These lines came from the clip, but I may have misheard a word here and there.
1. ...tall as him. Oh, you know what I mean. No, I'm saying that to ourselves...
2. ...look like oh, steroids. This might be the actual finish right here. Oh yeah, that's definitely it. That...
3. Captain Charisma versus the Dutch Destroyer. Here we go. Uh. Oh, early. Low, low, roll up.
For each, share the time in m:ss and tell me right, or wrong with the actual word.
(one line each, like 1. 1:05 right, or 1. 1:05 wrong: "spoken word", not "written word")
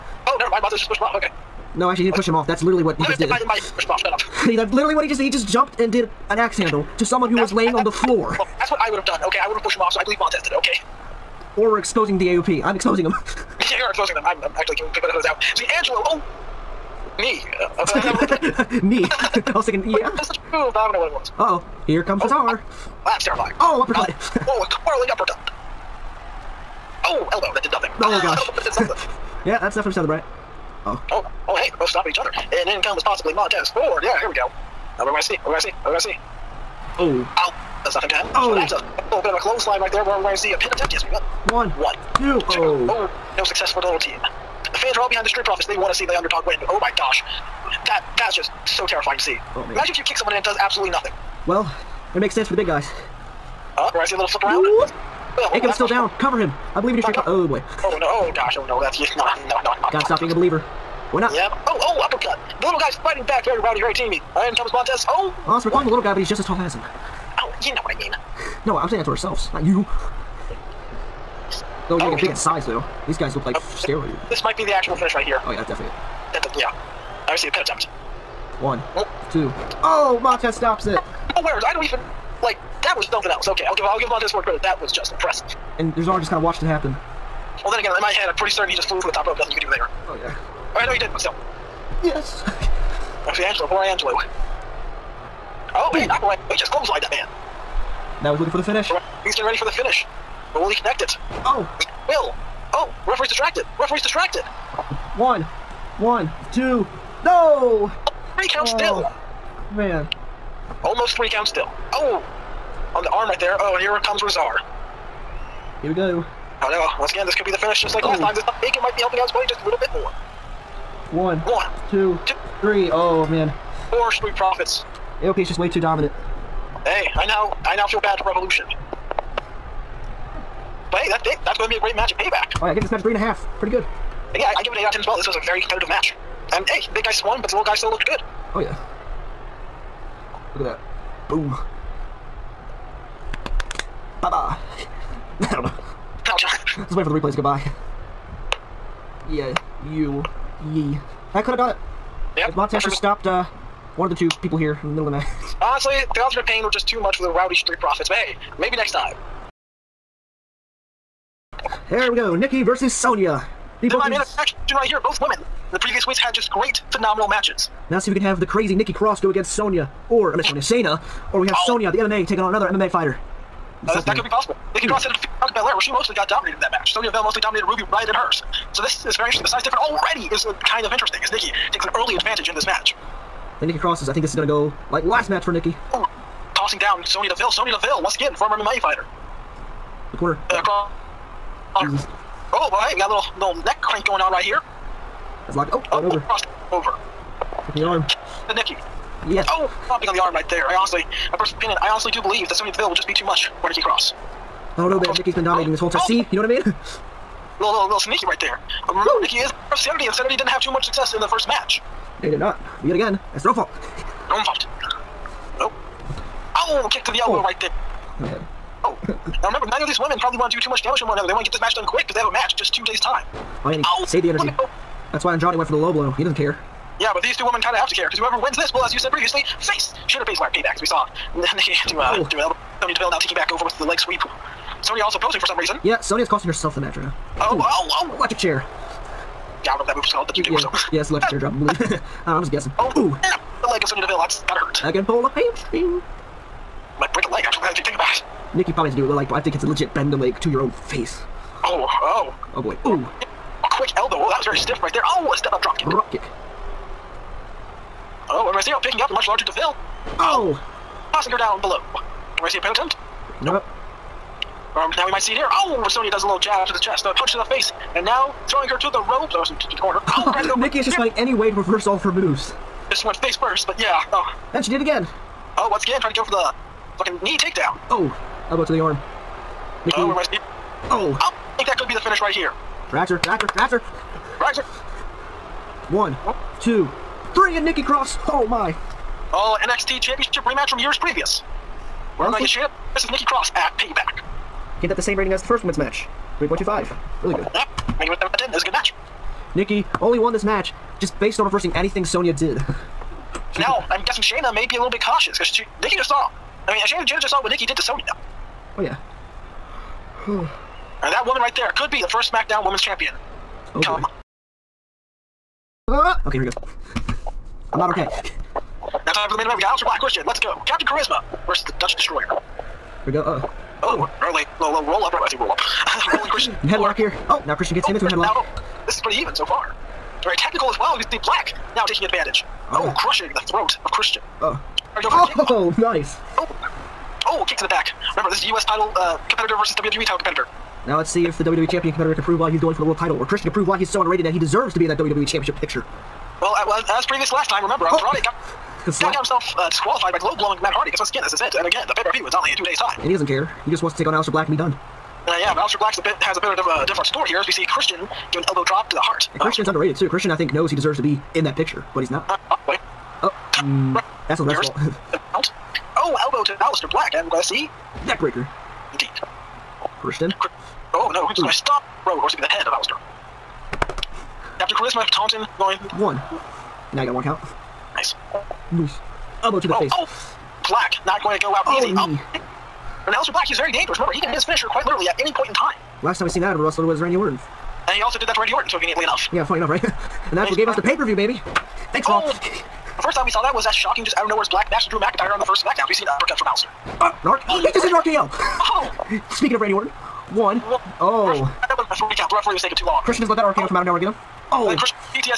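1. 1:06 right
2. 1:13 right
3. 5:20 right.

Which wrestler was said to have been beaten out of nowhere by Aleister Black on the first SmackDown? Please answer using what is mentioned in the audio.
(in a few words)
Drew McIntyre.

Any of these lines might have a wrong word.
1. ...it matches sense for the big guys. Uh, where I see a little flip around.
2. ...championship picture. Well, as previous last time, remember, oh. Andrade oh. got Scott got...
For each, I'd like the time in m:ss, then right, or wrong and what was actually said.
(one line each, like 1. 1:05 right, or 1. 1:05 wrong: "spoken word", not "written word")
1. 0:52 wrong: "makes", not "matches"
2. 5:45 right.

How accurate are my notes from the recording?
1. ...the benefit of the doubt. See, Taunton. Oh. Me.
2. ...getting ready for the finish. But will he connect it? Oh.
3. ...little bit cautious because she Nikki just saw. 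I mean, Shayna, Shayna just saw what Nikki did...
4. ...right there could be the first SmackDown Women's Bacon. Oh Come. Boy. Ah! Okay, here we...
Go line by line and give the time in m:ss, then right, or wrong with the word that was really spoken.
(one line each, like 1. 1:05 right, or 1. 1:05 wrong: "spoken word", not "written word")
1. 0:14 wrong: "Angelo", not "Taunton"
2. 1:39 right
3. 5:04 right
4. 5:11 wrong: "Champion", not "Bacon".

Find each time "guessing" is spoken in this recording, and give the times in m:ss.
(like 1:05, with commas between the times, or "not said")
4:02, 5:04.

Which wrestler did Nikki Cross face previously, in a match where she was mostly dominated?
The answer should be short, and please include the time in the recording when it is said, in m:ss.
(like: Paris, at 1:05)
Bianca Belair, at 2:55.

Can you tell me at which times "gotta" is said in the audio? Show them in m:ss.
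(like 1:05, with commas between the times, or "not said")
0:59, 4:04.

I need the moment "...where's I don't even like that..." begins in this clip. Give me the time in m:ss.
1:21.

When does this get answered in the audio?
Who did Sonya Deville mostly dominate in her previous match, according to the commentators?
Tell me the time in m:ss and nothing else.
2:57.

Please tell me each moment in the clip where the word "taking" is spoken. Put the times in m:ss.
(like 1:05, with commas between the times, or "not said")
2:52, 3:53, 5:31, 6:42.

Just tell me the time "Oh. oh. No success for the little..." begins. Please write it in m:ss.
0:42.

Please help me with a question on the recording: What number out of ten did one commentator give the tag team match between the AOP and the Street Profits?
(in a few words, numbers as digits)
8.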